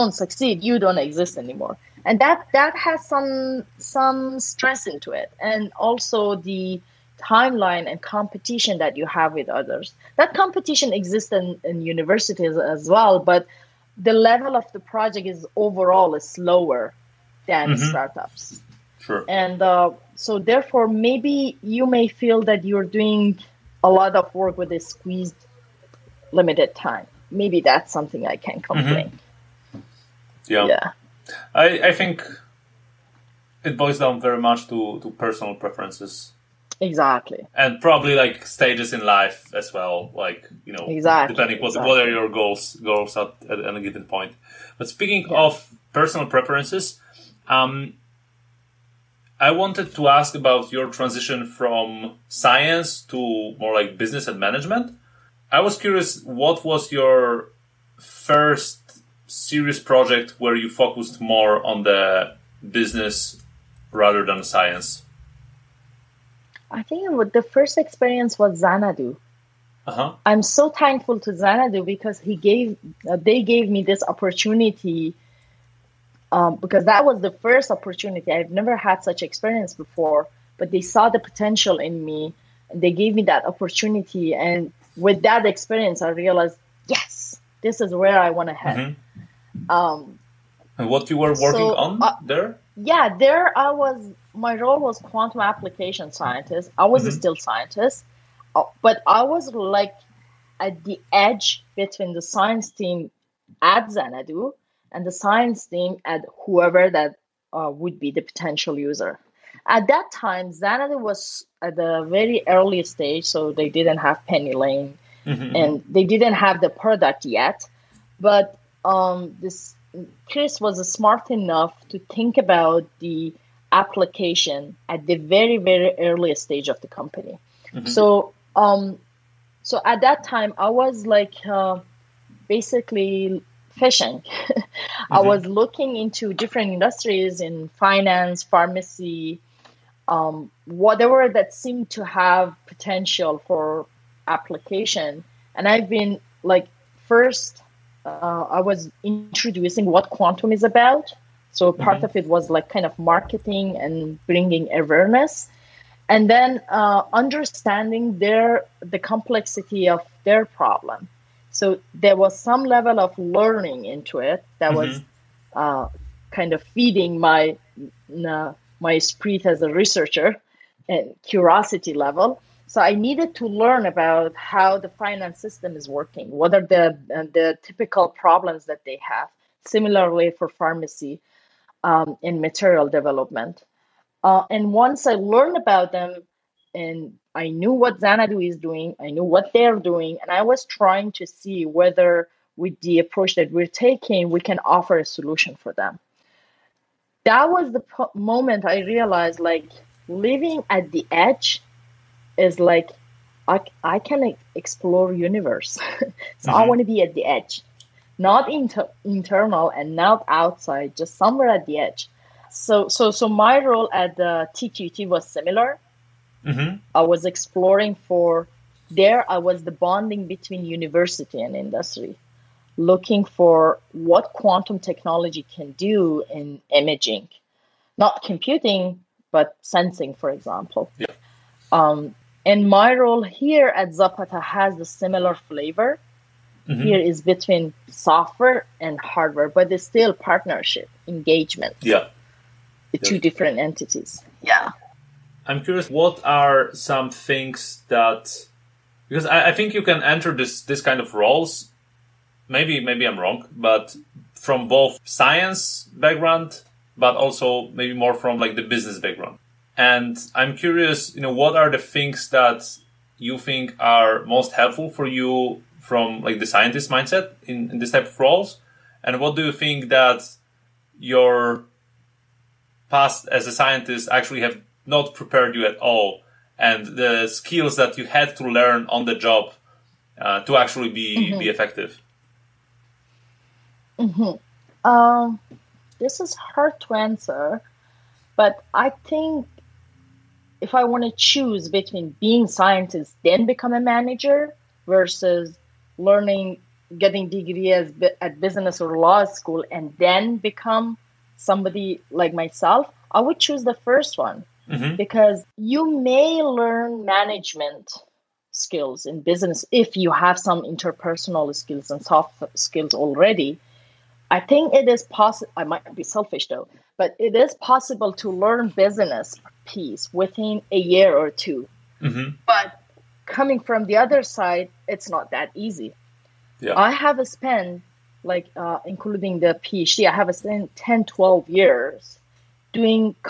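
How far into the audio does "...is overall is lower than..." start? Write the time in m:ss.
0:15.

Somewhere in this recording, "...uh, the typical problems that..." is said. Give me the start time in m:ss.
2:57.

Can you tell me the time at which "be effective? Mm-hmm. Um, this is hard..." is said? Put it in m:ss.
4:41.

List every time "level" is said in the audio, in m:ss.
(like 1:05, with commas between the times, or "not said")
0:14, 2:42, 2:51.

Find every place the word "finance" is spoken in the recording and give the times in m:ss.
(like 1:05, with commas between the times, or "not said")
2:17, 2:54.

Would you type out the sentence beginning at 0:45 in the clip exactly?
of personal preferences, um, I wanted to ask about your transition from science to more like business and management.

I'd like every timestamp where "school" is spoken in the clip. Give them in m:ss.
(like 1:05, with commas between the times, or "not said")
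4:59.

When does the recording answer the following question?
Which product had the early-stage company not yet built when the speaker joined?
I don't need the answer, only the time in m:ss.
1:54.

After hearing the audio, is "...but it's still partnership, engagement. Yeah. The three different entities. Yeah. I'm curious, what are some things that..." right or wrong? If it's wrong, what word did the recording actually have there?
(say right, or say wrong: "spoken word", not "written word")
wrong: "two", not "three".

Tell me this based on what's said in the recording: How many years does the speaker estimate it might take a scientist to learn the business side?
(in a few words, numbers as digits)
1 or 2.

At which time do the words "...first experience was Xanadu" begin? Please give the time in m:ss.
1:07.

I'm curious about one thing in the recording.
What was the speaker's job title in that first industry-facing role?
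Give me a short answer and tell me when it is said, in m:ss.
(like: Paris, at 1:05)
Quantum application scientist, at 1:34.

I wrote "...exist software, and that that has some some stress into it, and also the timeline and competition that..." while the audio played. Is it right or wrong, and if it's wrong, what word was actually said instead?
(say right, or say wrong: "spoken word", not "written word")
wrong: "anymore", not "software".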